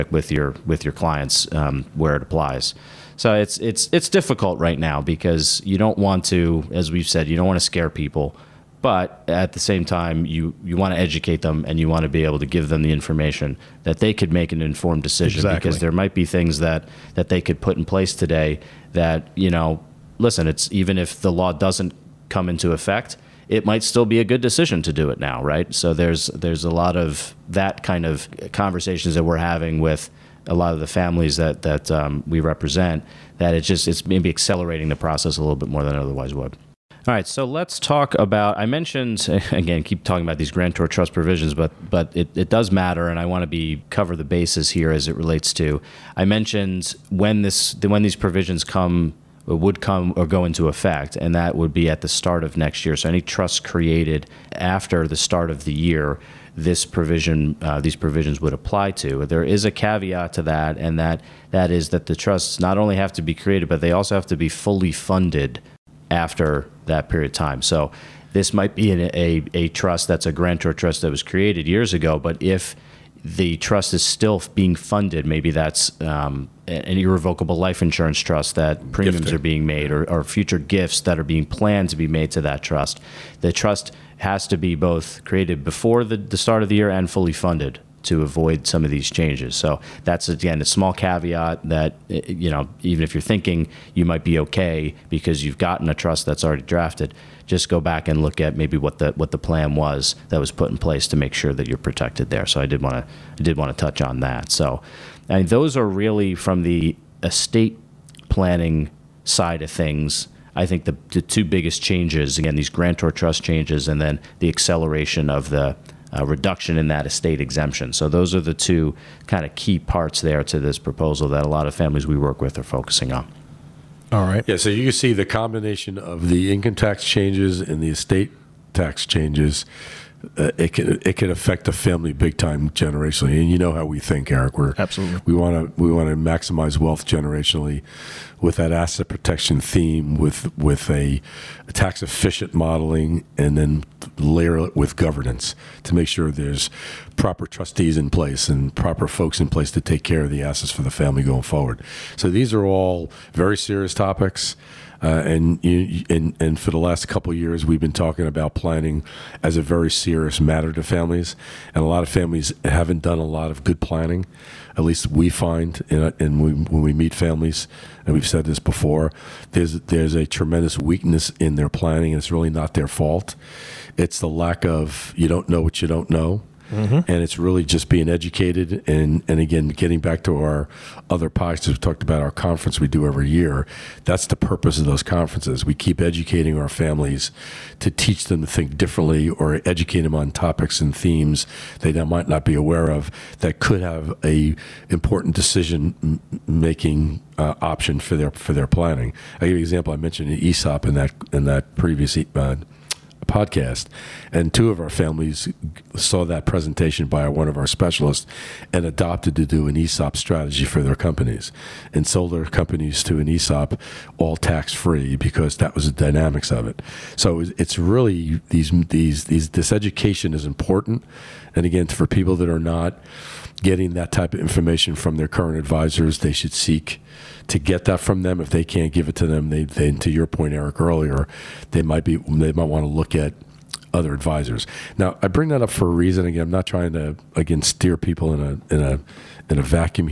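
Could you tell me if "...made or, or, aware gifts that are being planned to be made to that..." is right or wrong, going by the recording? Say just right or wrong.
wrong.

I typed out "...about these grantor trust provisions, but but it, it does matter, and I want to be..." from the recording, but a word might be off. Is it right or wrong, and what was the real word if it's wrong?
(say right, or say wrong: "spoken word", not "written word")
right.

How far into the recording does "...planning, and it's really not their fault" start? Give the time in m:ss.
2:51.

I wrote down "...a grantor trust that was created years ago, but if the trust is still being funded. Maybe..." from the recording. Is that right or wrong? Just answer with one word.
right.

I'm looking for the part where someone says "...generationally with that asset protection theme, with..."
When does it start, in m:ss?
2:17.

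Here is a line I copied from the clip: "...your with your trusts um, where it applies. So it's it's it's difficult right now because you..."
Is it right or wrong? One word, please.
wrong.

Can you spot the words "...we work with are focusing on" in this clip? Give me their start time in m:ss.
2:02.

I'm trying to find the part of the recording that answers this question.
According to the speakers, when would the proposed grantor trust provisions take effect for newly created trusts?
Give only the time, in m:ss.
0:51.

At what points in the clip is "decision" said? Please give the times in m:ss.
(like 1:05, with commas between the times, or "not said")
0:15, 0:24, 3:15.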